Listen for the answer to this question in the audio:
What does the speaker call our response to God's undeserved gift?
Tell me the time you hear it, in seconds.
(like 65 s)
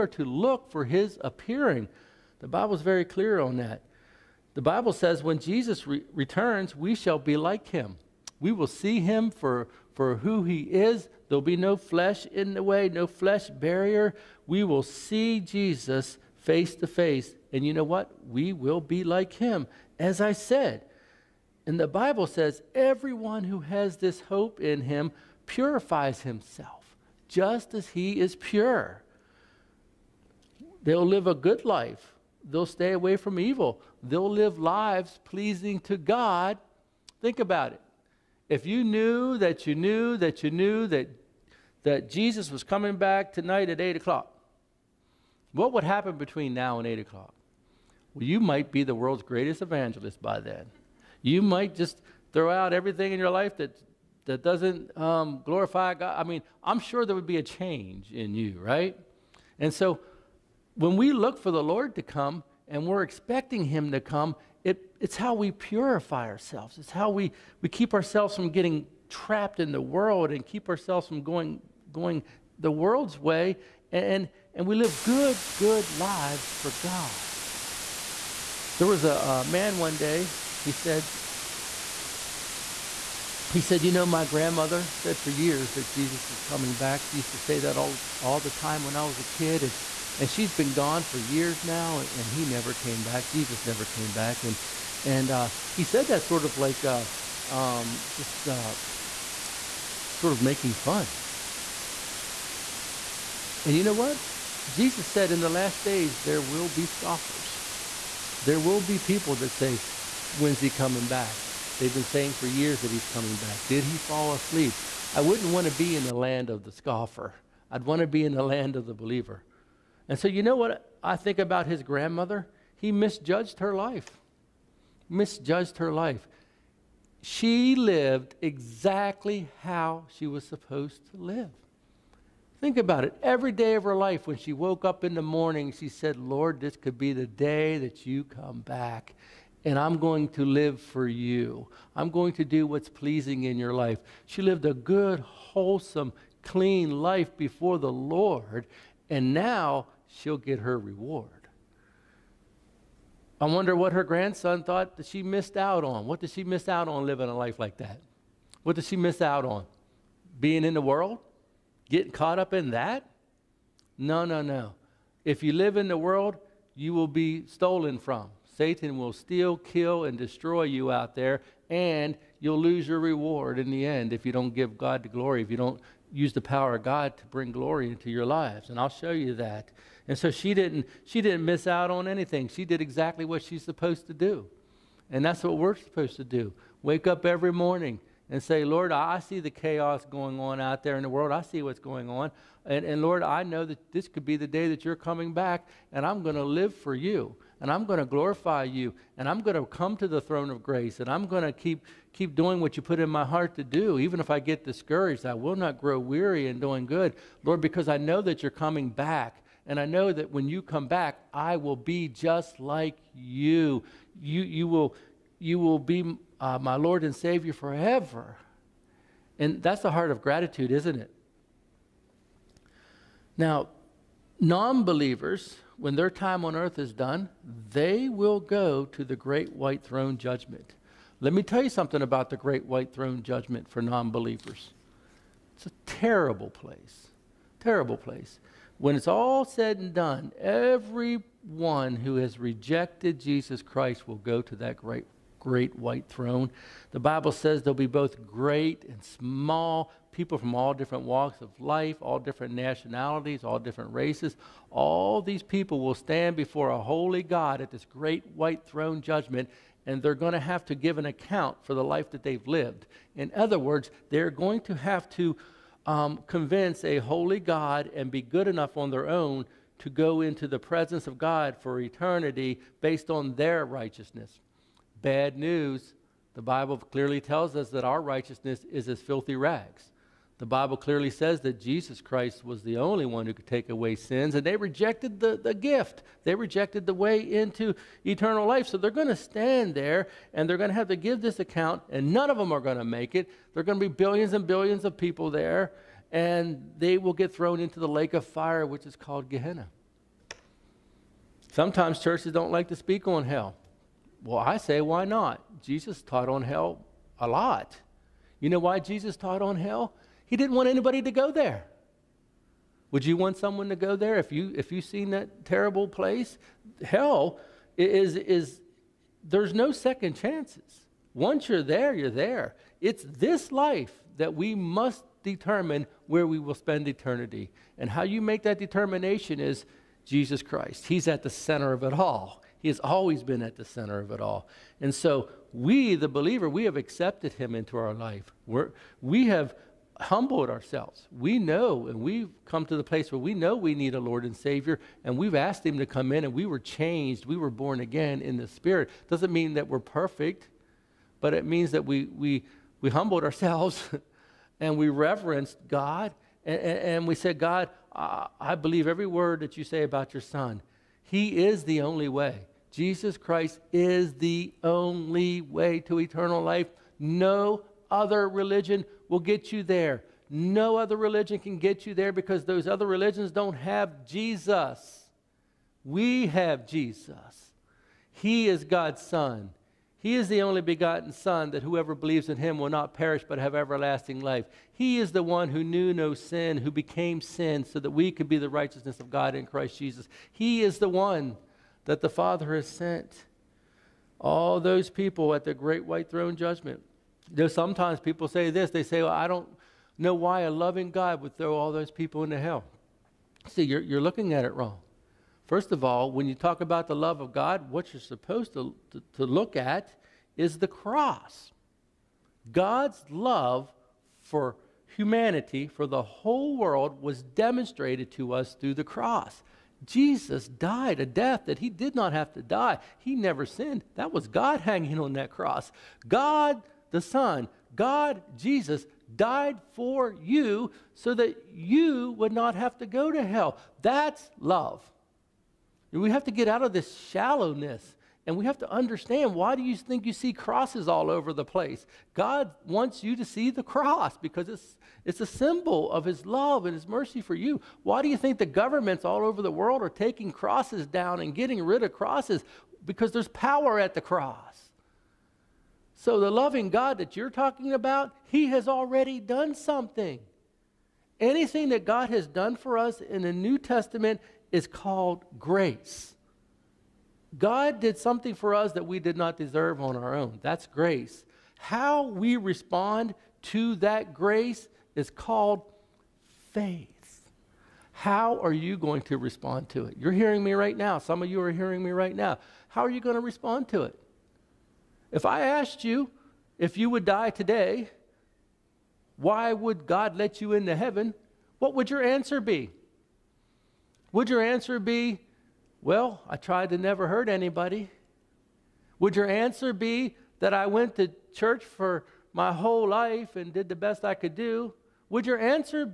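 476 s.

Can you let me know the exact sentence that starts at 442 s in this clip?
God wants you to see the cross because it's, it's a symbol of his love and his mercy for you.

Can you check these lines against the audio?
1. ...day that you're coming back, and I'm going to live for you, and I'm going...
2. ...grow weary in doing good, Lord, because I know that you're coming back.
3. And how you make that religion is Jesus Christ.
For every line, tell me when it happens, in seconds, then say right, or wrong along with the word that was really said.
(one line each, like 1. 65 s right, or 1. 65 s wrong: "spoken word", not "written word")
1. 194 s right
2. 205 s right
3. 327 s wrong: "determination", not "religion".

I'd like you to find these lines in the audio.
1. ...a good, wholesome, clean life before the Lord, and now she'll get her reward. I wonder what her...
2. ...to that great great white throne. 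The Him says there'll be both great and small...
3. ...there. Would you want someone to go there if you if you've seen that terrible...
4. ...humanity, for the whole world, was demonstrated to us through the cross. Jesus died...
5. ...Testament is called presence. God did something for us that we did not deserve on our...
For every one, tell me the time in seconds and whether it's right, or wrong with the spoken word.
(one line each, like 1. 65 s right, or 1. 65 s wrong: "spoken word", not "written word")
1. 144 s right
2. 244 s wrong: "Bible", not "Him"
3. 311 s right
4. 414 s right
5. 463 s wrong: "grace", not "presence".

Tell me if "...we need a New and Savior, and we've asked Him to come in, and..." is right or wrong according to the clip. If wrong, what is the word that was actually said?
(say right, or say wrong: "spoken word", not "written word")
wrong: "Lord", not "New".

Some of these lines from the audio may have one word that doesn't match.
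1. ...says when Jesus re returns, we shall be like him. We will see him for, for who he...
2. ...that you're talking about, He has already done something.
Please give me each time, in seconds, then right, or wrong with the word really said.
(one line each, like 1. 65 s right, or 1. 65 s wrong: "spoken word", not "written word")
1. 4 s right
2. 456 s right.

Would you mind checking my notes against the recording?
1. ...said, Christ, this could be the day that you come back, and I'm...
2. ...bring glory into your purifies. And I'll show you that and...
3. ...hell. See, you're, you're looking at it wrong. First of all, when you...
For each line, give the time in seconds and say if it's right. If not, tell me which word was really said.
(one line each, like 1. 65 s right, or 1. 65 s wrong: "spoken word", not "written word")
1. 135 s wrong: "Lord", not "Christ"
2. 177 s wrong: "lives", not "purifies"
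3. 402 s right.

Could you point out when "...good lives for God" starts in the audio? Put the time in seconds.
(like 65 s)
75 s.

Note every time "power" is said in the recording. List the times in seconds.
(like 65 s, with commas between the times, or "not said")
176 s, 453 s.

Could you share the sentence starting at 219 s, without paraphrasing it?
And that's the heart of gratitude, isn't it?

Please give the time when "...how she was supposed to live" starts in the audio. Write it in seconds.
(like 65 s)
129 s.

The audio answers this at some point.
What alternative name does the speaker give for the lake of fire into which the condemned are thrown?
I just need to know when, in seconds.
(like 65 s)
299 s.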